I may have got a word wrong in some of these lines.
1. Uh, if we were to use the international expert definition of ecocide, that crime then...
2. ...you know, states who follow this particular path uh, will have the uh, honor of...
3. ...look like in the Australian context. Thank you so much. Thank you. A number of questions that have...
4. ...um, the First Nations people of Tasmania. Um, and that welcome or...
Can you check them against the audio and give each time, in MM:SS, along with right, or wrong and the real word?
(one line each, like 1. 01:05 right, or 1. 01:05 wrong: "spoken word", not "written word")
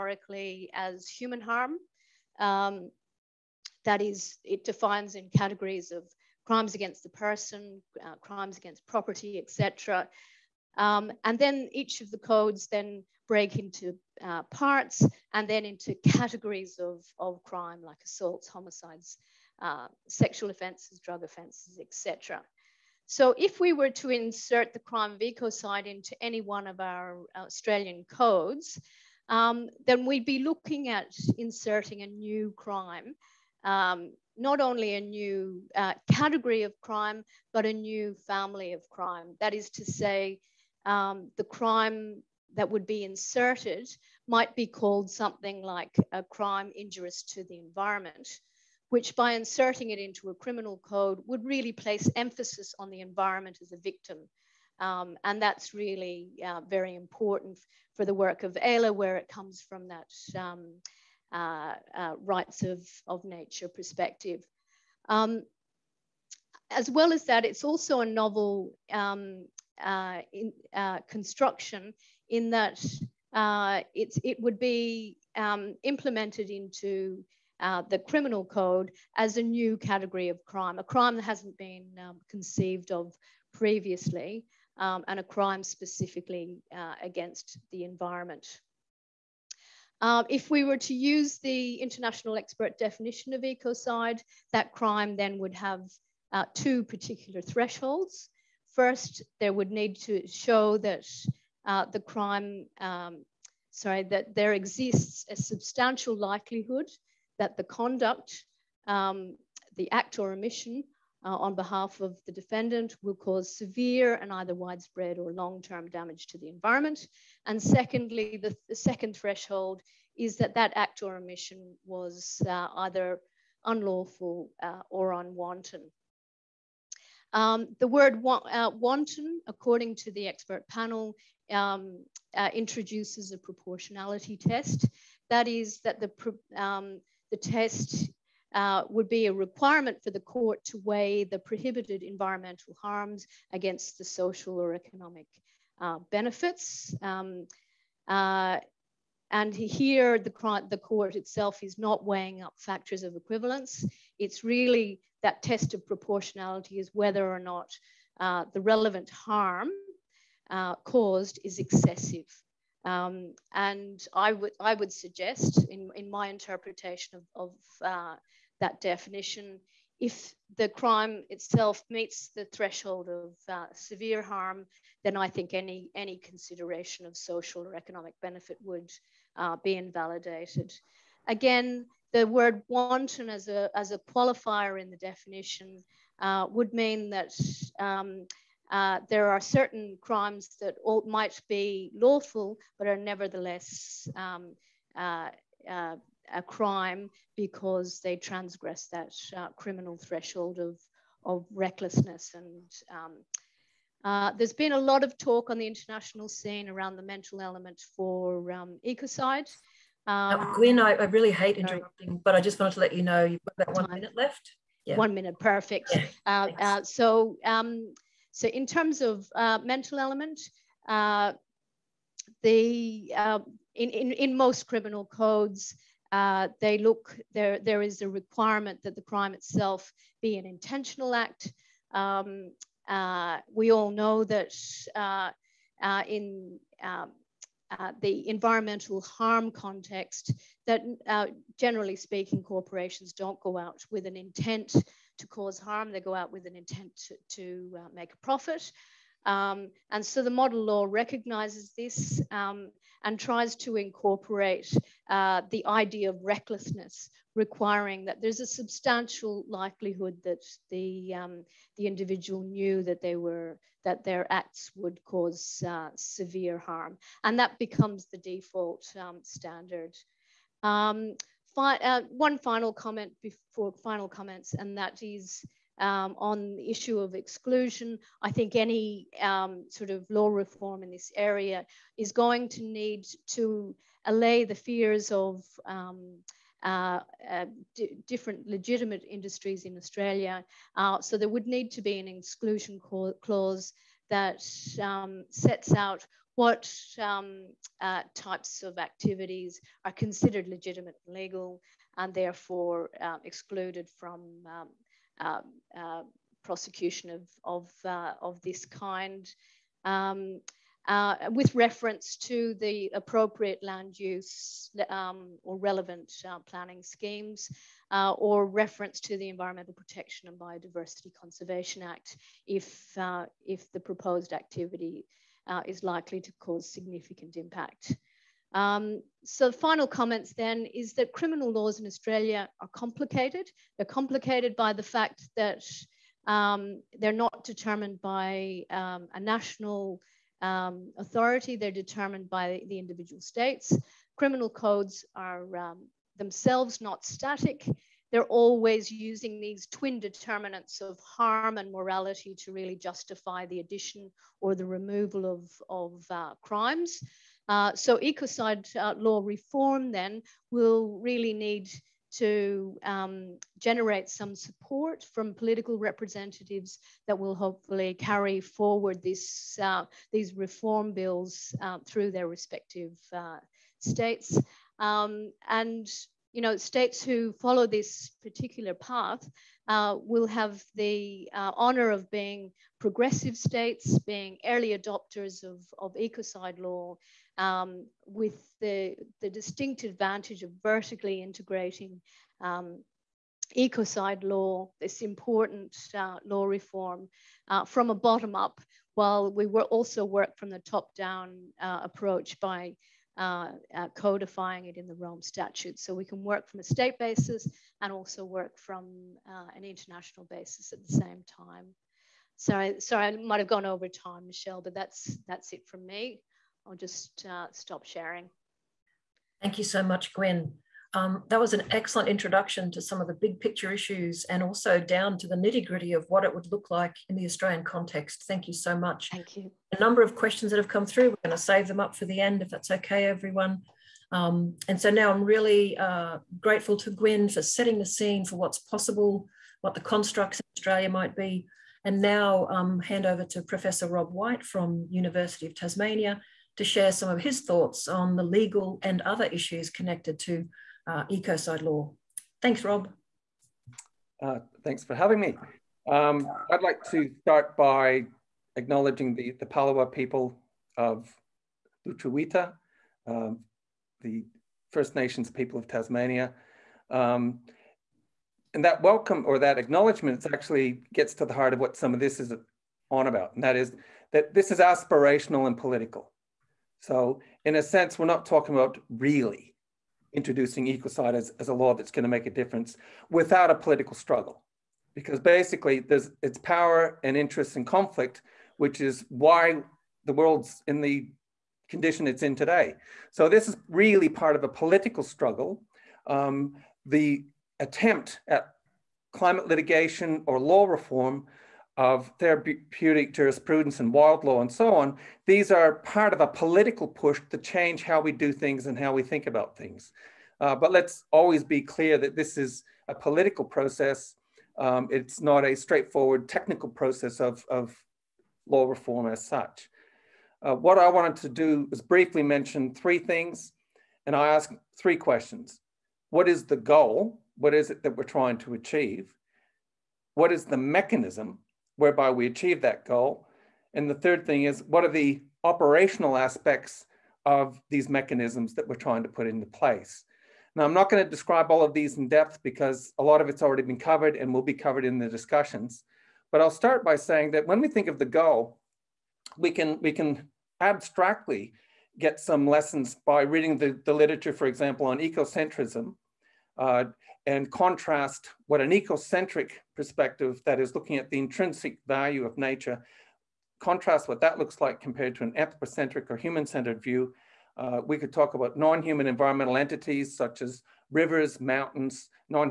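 1. 01:30 right
2. 06:16 right
3. 07:06 right
4. 07:43 right.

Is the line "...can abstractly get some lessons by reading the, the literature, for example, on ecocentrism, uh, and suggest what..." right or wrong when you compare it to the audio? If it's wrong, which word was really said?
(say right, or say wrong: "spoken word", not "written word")
wrong: "contrast", not "suggest".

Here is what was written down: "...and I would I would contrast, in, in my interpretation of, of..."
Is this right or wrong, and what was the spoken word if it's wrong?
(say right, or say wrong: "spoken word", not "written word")
wrong: "suggest", not "contrast".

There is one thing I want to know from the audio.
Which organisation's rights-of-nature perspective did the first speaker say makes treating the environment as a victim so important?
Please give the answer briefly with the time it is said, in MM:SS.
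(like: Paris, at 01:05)
AELA, at 00:58.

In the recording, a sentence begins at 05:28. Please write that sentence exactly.
Um, so final comments then is that criminal laws in Australia are complicated.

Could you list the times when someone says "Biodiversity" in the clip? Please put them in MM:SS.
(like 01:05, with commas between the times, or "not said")
05:20.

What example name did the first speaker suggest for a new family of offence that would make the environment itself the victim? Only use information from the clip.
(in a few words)
crime injurious to the environment.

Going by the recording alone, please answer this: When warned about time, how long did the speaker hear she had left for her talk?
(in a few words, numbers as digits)
1 minute.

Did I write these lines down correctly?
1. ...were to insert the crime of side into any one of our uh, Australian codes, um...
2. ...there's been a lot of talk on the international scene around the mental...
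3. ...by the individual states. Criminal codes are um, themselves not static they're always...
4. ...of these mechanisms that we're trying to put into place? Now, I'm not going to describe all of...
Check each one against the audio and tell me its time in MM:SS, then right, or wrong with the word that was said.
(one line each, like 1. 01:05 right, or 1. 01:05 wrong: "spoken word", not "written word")
1. 00:23 right
2. 03:24 right
3. 05:42 right
4. 08:57 right.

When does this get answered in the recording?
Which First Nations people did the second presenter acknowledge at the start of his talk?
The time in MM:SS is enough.
07:39.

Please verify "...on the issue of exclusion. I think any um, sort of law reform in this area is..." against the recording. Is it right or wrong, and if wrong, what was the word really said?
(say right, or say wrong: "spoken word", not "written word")
right.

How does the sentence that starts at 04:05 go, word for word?
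They go out with an intent to, to uh, make a profit.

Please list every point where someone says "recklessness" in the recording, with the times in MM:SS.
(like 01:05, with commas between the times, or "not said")
03:21, 04:16.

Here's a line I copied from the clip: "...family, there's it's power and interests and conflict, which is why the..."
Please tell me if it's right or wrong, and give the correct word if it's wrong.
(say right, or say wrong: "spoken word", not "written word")
wrong: "basically", not "family".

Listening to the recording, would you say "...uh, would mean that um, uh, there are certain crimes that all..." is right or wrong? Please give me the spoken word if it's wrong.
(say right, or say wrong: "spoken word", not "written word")
right.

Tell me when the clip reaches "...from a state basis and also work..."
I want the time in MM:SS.
06:46.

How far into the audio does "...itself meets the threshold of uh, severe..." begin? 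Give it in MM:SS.
02:51.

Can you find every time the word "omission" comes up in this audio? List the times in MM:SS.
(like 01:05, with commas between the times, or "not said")
01:50, 02:01.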